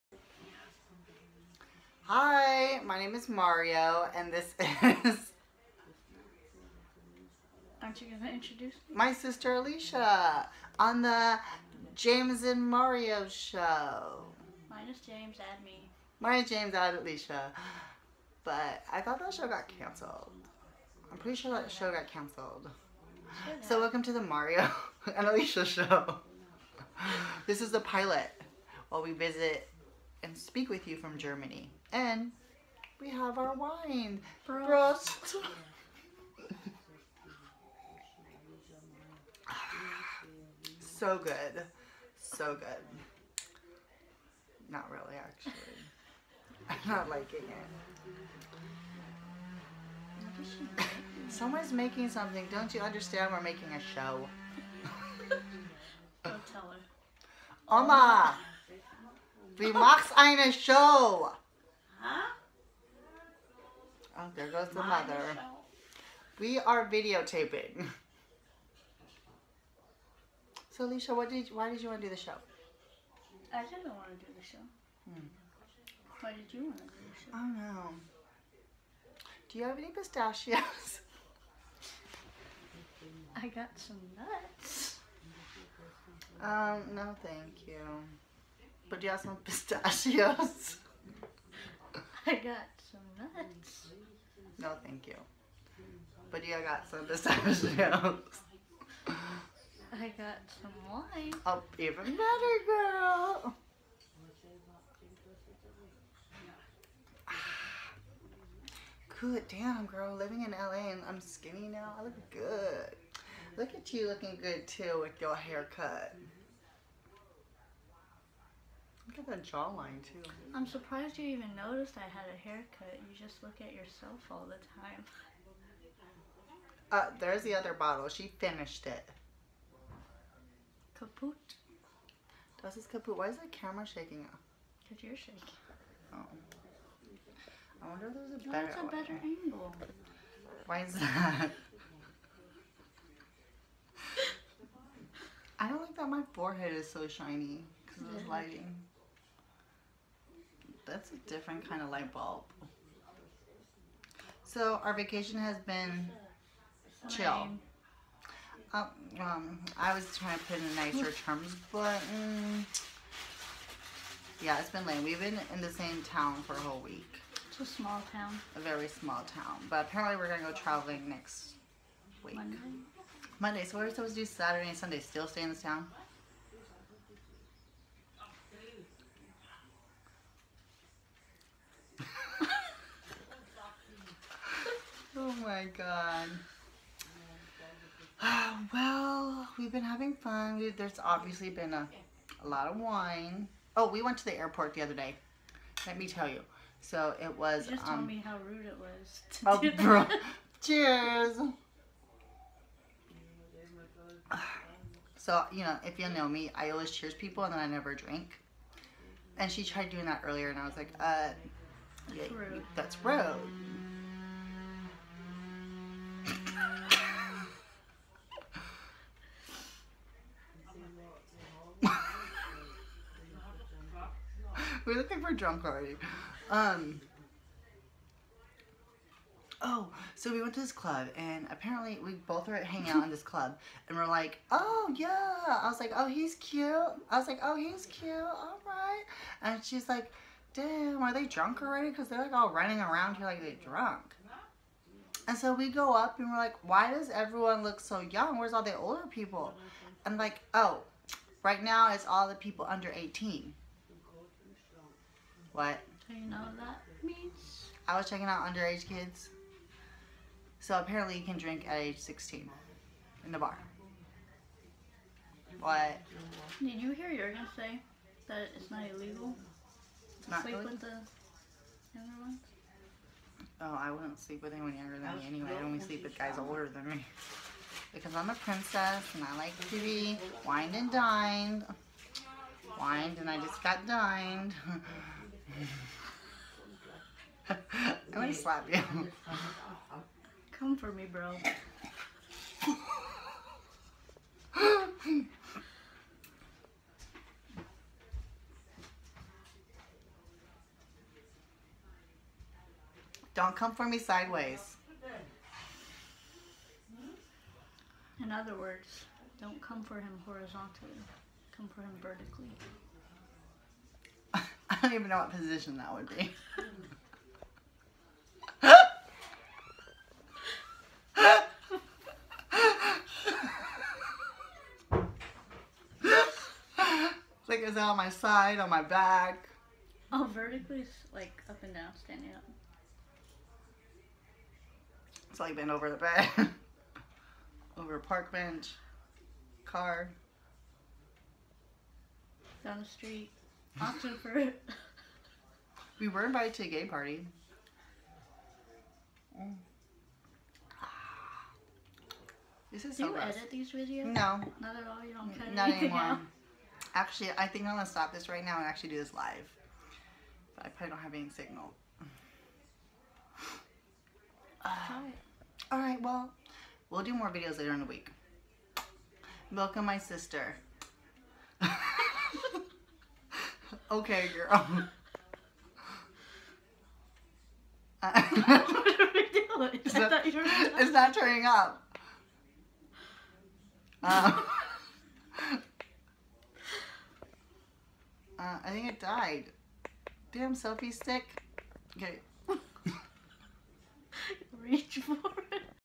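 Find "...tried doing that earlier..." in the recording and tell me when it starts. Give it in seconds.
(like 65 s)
209 s.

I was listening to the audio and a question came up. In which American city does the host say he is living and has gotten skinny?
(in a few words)
LA.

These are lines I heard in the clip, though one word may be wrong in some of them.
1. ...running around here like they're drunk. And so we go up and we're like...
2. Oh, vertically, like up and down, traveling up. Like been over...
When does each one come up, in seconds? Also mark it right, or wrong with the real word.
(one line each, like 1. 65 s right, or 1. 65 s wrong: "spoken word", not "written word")
1. 242 s right
2. 330 s wrong: "standing", not "traveling".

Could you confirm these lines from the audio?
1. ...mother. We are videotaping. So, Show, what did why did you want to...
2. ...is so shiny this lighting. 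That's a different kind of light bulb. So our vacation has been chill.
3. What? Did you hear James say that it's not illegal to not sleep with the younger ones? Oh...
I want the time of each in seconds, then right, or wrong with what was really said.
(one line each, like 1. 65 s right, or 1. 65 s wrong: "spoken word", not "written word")
1. 64 s wrong: "Alisha", not "Show"
2. 146 s right
3. 265 s wrong: "Jurgen", not "James".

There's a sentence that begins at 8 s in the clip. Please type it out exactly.
My sister Alisha on the James and Mario show.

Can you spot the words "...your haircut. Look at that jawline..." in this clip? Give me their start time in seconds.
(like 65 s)
115 s.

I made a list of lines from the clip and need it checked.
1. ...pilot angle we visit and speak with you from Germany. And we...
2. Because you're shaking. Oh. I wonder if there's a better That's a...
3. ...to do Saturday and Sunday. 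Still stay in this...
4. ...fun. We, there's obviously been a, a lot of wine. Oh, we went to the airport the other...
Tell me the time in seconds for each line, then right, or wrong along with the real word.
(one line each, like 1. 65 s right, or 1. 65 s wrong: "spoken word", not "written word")
1. 27 s wrong: "while", not "angle"
2. 134 s right
3. 174 s right
4. 190 s right.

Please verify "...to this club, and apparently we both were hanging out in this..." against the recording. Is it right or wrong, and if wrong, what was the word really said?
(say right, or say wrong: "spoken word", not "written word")
right.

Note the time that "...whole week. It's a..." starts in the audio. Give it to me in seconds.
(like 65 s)
166 s.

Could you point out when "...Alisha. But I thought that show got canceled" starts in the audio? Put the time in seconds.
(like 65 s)
17 s.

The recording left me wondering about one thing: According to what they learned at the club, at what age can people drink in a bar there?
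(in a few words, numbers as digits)
16.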